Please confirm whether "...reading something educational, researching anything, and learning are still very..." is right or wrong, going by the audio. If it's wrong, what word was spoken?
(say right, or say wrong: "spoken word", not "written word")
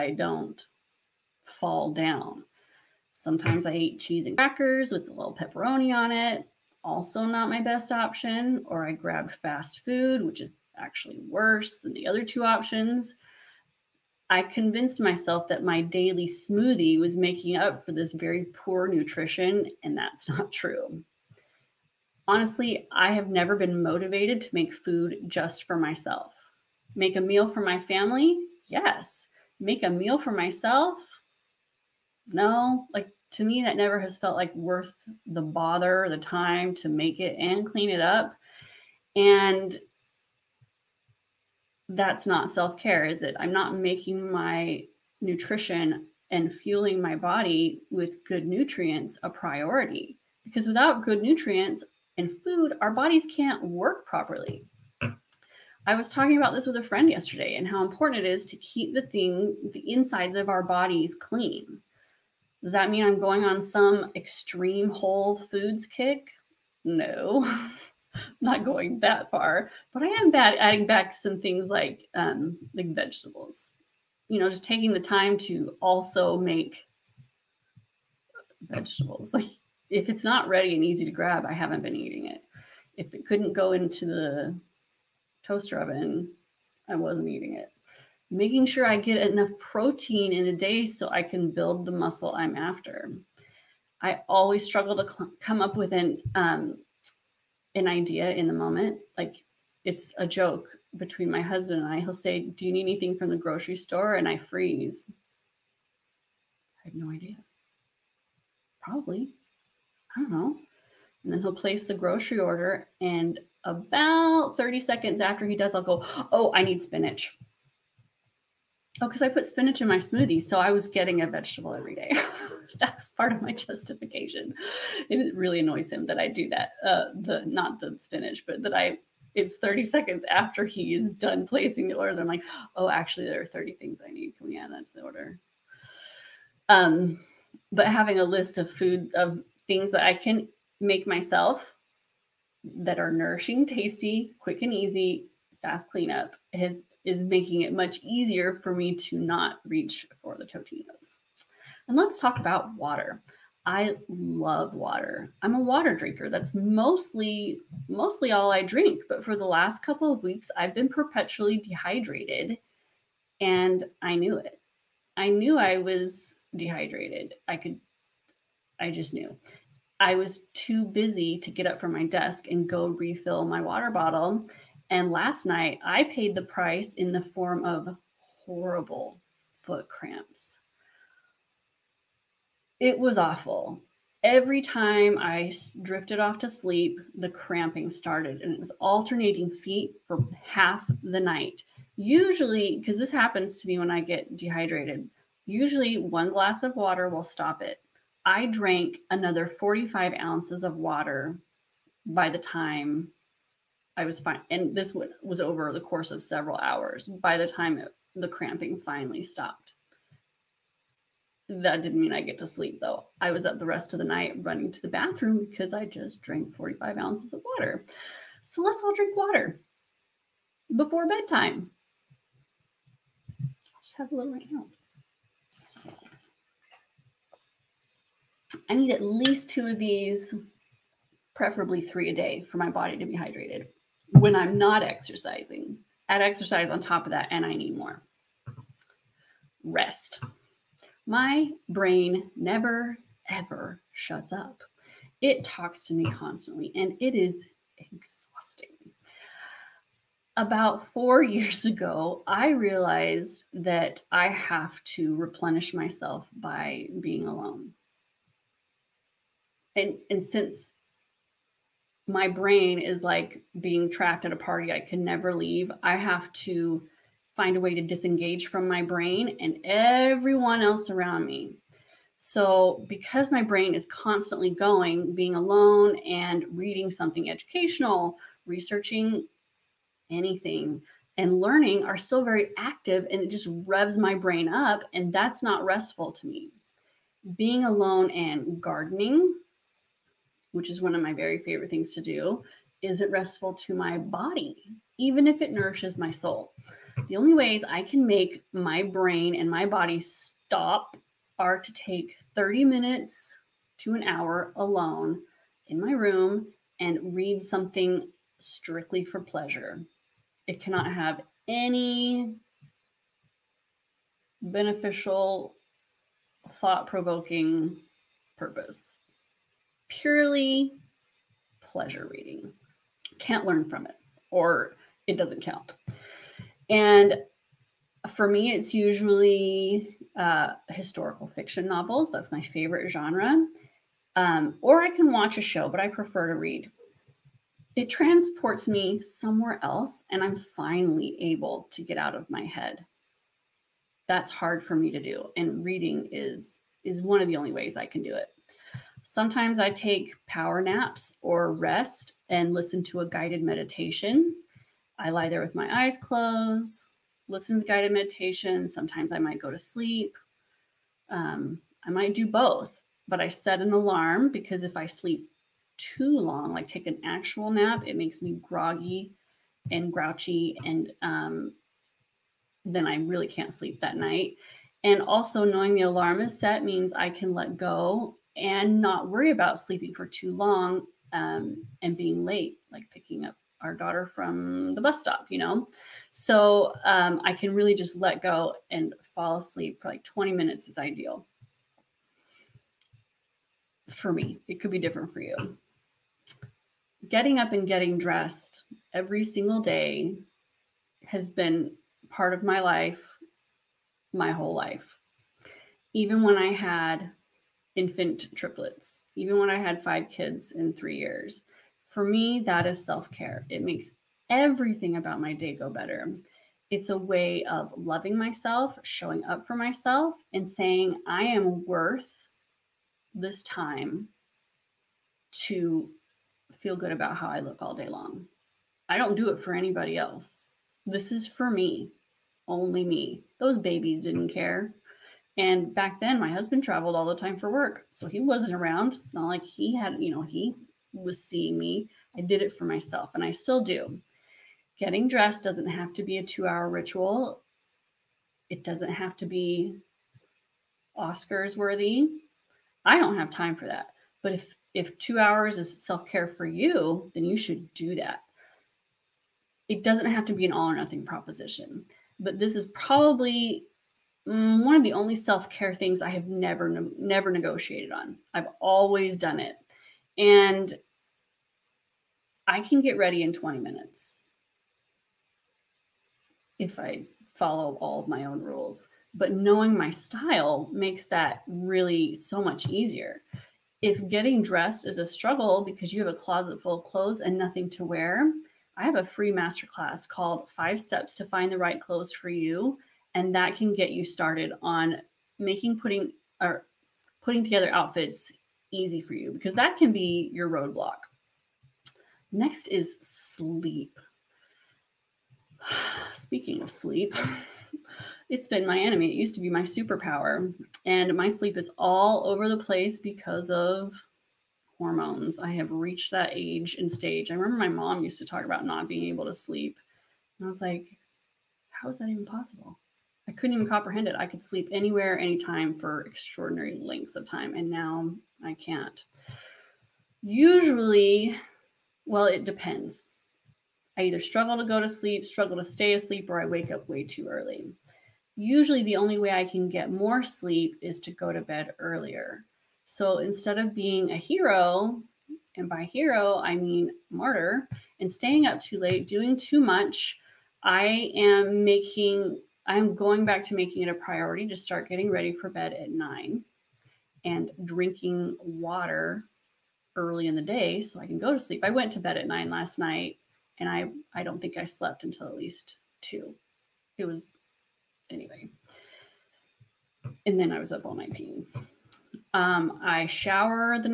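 right.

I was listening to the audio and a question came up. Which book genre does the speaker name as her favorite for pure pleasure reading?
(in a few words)
historical fiction.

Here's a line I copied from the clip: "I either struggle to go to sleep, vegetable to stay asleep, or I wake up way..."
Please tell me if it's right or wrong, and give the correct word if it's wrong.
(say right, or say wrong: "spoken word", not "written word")
wrong: "struggle", not "vegetable".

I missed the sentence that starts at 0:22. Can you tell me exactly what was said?
Honestly, I have never been motivated to make food just for myself.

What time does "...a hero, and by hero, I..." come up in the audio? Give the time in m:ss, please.
9:04.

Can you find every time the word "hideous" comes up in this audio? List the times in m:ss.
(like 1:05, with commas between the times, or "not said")
not said.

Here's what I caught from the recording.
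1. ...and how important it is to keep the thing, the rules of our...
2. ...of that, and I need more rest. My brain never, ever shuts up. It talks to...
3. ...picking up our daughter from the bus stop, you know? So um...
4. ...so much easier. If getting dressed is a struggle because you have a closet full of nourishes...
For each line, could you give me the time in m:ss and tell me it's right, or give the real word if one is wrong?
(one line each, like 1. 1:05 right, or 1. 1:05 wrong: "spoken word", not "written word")
1. 0:57 wrong: "insides", not "rules"
2. 3:57 right
3. 6:22 right
4. 8:02 wrong: "clothes", not "nourishes".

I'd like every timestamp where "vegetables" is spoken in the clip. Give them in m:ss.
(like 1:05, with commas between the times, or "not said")
1:12, 1:18, 2:01.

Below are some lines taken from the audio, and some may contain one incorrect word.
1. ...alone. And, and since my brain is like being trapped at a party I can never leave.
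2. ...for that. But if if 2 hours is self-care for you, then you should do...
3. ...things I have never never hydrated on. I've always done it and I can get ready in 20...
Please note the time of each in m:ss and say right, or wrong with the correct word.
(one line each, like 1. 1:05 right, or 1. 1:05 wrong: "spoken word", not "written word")
1. 4:17 right
2. 7:33 right
3. 7:45 wrong: "negotiated", not "hydrated".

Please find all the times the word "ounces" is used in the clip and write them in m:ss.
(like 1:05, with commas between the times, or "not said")
3:20, 3:36.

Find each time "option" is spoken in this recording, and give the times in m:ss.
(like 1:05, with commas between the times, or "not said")
0:07, 0:12.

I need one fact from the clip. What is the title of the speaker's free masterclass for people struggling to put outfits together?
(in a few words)
Five Steps to Find the Right Clothes for You.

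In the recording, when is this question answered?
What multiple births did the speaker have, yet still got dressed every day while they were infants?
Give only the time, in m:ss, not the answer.
6:48.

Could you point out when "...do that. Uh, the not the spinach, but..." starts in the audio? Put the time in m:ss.
2:06.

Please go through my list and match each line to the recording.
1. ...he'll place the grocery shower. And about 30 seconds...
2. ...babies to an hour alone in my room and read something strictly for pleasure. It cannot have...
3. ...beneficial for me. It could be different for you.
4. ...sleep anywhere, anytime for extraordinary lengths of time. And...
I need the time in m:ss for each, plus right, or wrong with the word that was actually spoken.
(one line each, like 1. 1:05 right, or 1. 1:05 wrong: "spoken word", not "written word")
1. 1:51 wrong: "order", not "shower"
2. 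5:02 wrong: "minutes", not "babies"
3. 6:30 wrong: "ideal", not "beneficial"
4. 8:44 right.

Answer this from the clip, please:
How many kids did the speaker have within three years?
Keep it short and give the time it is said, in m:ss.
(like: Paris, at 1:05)
5, at 6:49.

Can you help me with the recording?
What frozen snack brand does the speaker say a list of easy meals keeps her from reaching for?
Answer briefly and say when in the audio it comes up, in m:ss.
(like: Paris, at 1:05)
Totinos, at 2:30.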